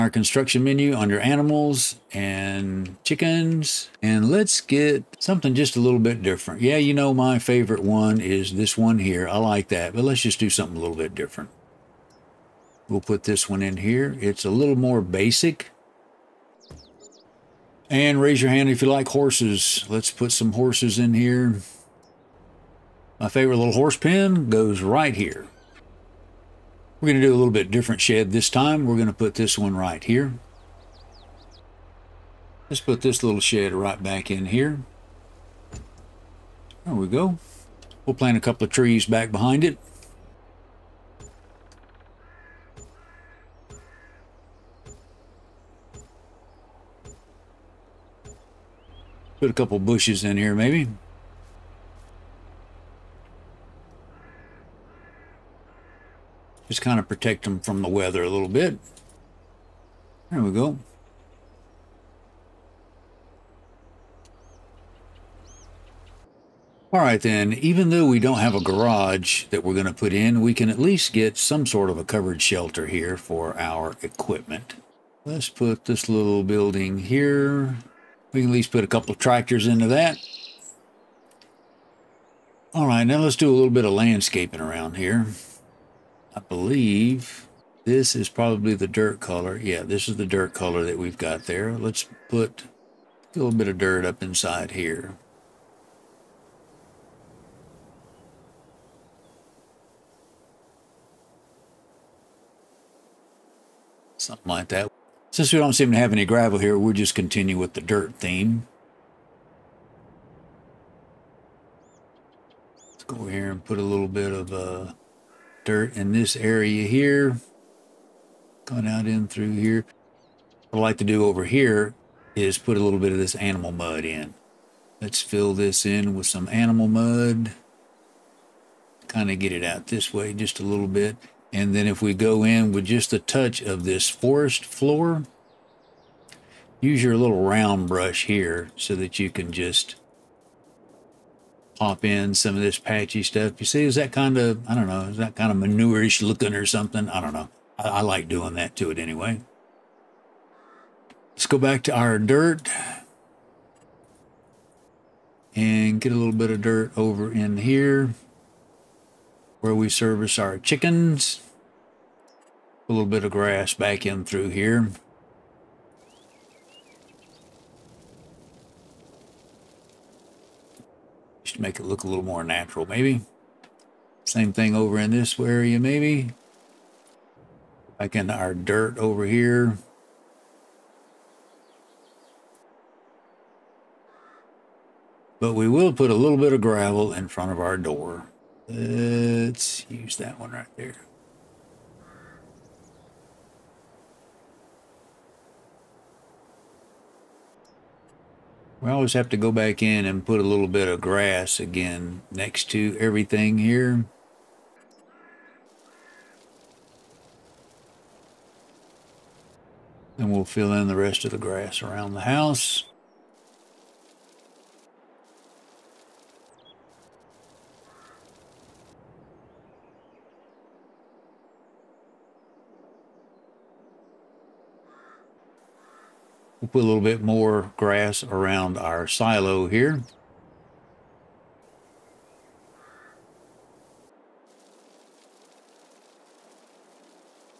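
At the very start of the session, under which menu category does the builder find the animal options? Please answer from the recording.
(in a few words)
Animals and chickens.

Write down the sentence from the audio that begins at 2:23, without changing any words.
You see, is that kind of, I don't know, is that kind of manureish looking or something?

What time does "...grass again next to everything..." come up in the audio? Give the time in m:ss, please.
3:20.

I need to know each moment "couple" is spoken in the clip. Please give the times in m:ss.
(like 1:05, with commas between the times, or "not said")
0:38, 0:49, 1:18.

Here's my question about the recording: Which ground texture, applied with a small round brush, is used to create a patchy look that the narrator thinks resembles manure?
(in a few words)
Forest floor.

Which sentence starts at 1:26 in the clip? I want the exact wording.
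I believe this is probably the dirt color.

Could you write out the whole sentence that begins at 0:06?
Yeah, you know, my favorite one is this one here.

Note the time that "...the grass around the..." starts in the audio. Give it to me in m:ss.
3:31.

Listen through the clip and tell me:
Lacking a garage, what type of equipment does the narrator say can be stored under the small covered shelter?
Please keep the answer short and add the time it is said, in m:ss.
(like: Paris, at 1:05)
Tractors, at 1:19.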